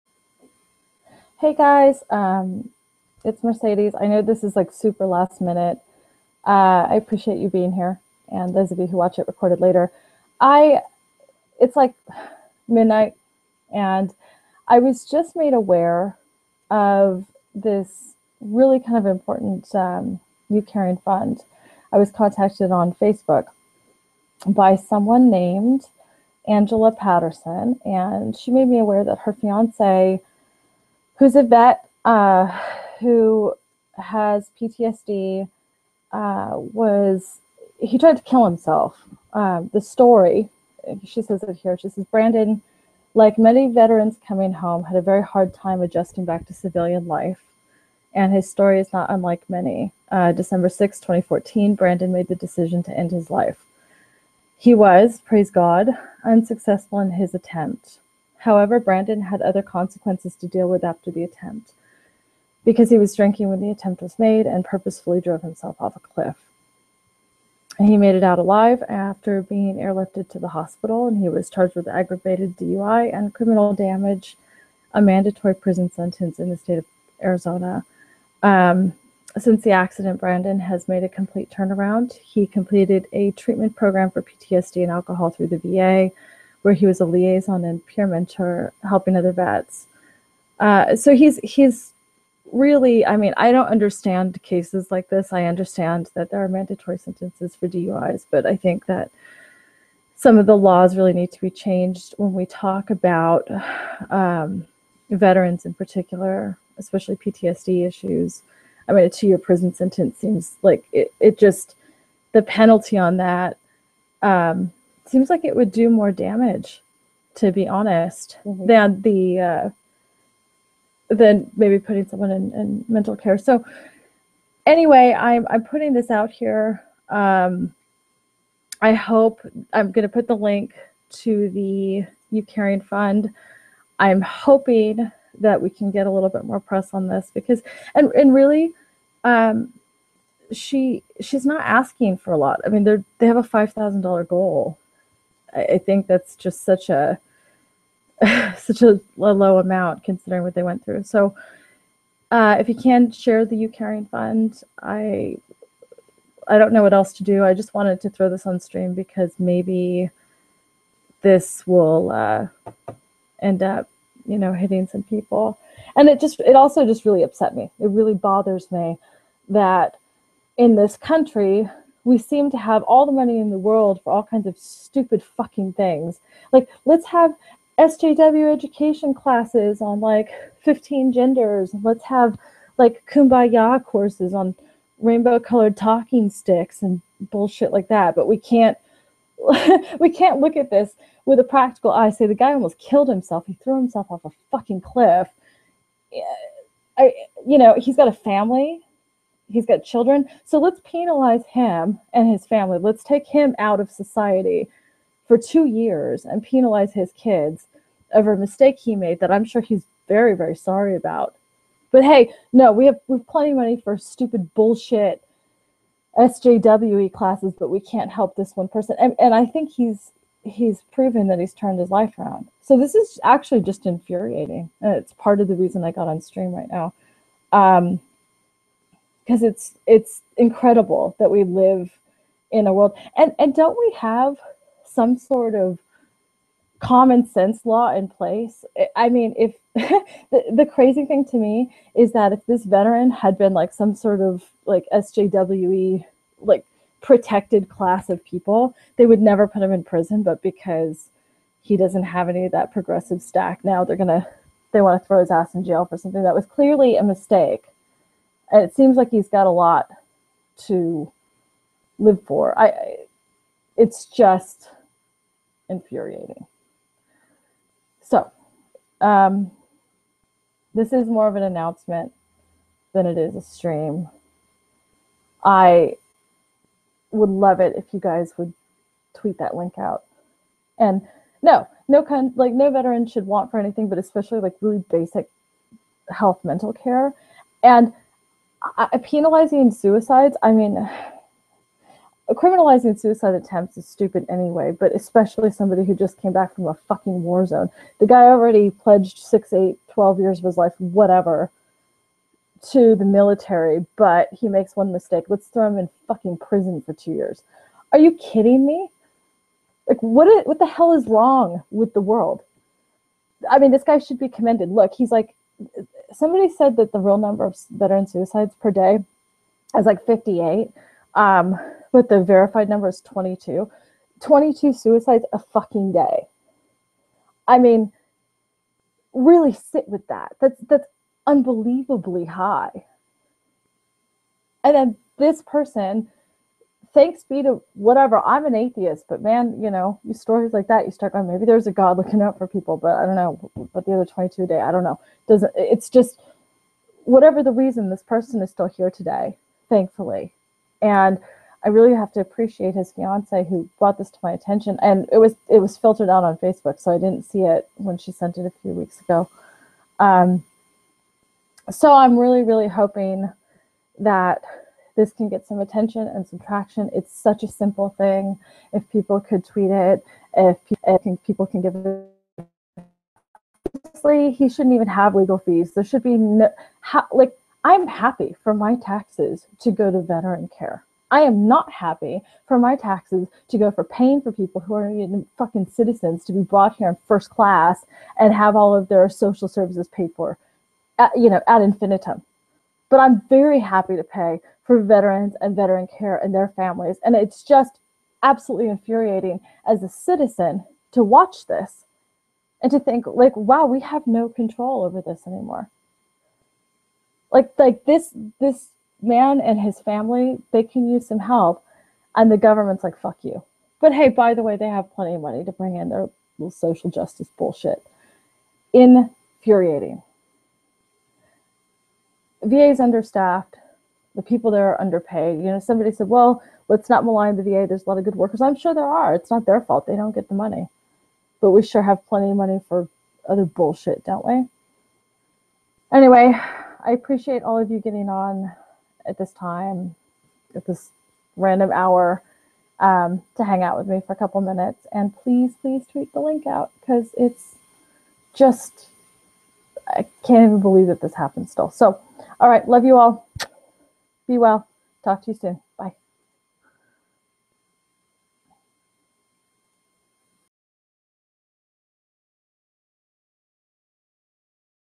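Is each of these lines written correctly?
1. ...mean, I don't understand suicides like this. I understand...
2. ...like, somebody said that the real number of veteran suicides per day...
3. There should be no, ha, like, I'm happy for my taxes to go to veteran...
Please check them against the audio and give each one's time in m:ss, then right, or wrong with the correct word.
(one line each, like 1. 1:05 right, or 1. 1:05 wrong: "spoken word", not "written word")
1. 1:33 wrong: "cases", not "suicides"
2. 5:15 right
3. 6:15 right.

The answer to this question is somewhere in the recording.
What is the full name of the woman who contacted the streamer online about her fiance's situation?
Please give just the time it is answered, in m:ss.
0:26.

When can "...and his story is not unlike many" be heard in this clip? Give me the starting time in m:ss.
0:48.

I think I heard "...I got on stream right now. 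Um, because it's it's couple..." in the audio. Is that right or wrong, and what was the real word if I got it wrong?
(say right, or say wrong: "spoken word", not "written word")
wrong: "incredible", not "couple".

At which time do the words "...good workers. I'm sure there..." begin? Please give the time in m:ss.
7:08.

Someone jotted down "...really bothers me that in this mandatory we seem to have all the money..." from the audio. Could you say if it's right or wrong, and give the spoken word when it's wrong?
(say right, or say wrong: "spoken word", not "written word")
wrong: "country", not "mandatory".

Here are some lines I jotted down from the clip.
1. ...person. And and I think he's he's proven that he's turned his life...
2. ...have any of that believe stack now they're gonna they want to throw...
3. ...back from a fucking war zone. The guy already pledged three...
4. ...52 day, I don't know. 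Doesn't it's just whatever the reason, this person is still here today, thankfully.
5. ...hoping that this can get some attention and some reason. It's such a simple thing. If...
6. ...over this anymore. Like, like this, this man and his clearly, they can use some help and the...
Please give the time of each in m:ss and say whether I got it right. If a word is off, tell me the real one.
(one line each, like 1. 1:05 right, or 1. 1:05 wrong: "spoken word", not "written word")
1. 3:38 right
2. 4:12 wrong: "progressive", not "believe"
3. 4:56 wrong: "six", not "three"
4. 5:44 wrong: "22", not "52"
5. 6:02 wrong: "traction", not "reason"
6. 6:44 wrong: "family", not "clearly".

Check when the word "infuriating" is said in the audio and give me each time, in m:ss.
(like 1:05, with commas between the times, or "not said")
3:43, 4:25, 6:38, 6:58.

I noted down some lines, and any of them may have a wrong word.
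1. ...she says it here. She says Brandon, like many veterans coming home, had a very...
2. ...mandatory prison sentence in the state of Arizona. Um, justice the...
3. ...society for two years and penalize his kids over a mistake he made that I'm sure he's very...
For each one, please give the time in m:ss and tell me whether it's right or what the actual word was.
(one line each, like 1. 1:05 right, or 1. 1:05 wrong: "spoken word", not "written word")
1. 0:41 right
2. 1:15 wrong: "since", not "justice"
3. 3:23 right.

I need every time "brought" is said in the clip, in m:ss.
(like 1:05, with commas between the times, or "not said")
5:53, 6:26.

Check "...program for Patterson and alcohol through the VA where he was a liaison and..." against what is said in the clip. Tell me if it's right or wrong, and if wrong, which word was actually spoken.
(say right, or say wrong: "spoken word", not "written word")
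wrong: "PTSD", not "Patterson".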